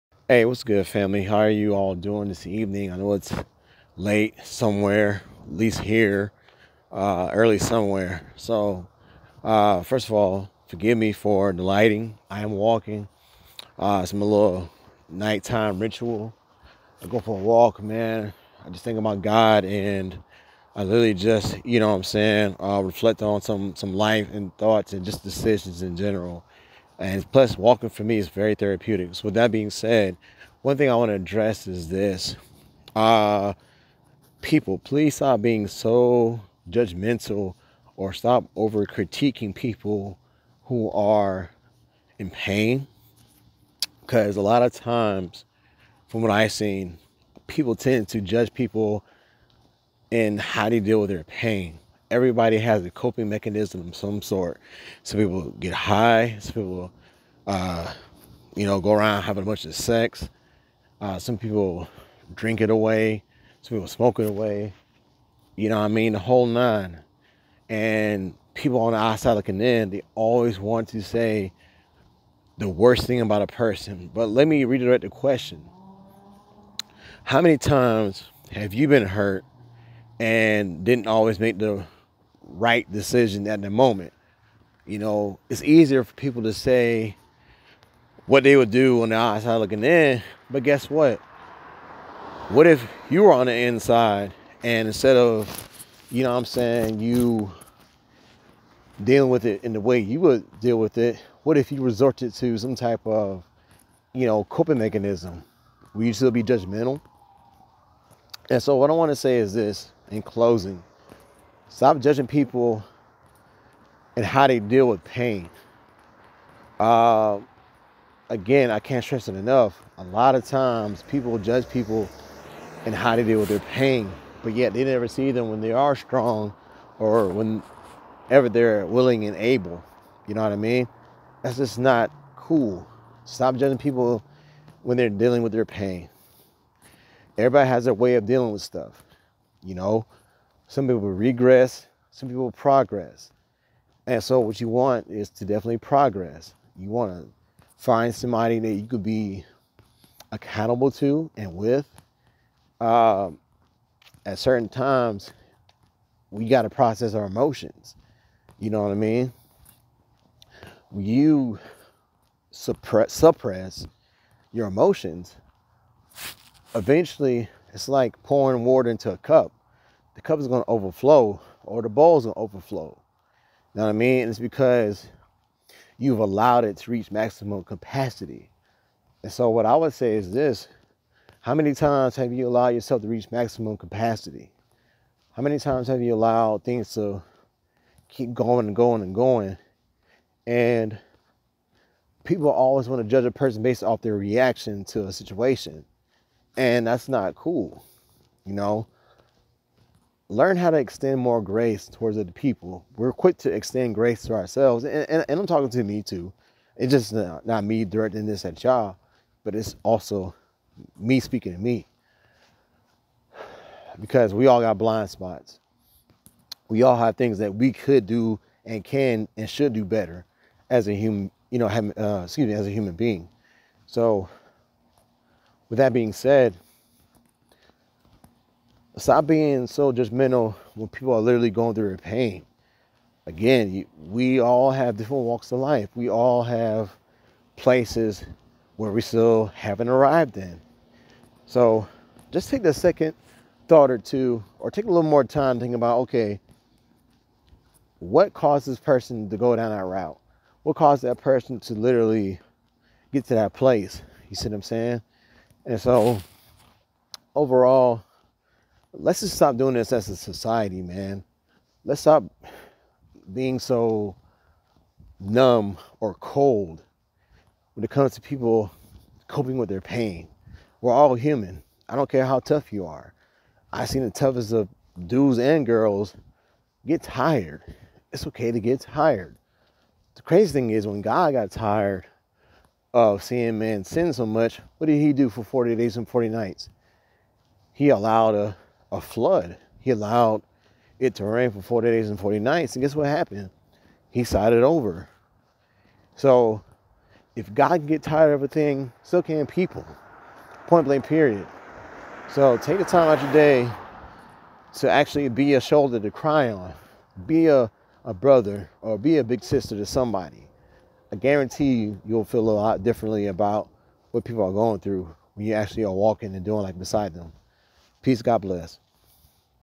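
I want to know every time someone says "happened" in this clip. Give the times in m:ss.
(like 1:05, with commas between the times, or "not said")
4:53.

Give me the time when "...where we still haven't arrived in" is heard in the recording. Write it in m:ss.
3:58.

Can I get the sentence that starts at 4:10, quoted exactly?
What caused that person to literally get to that place?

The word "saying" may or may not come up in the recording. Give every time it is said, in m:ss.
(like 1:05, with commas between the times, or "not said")
0:22, 1:36, 4:14.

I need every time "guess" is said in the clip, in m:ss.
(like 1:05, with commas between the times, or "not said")
1:30, 4:52.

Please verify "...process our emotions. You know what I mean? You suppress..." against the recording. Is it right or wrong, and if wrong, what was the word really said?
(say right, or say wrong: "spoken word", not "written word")
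right.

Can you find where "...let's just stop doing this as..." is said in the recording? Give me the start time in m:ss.
4:18.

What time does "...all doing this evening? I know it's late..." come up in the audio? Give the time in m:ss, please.
0:01.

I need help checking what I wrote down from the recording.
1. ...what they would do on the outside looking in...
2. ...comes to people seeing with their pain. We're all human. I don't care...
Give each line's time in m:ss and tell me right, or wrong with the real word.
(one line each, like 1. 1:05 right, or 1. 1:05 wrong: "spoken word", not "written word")
1. 1:28 right
2. 4:27 wrong: "coping", not "seeing".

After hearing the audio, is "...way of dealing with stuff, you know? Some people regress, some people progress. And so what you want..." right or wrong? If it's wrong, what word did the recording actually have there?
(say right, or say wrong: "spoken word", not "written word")
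right.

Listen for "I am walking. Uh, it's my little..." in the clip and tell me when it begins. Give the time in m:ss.
0:12.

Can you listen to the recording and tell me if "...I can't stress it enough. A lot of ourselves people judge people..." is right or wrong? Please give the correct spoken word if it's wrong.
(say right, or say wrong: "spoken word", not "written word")
wrong: "times", not "ourselves".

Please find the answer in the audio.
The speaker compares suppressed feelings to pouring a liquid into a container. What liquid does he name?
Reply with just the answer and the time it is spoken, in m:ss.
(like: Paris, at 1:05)
Water, at 2:48.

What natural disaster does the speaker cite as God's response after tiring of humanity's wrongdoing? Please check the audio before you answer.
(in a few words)
A flood.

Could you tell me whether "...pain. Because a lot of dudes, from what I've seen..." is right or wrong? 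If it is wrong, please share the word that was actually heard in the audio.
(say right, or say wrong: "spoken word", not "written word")
wrong: "times", not "dudes".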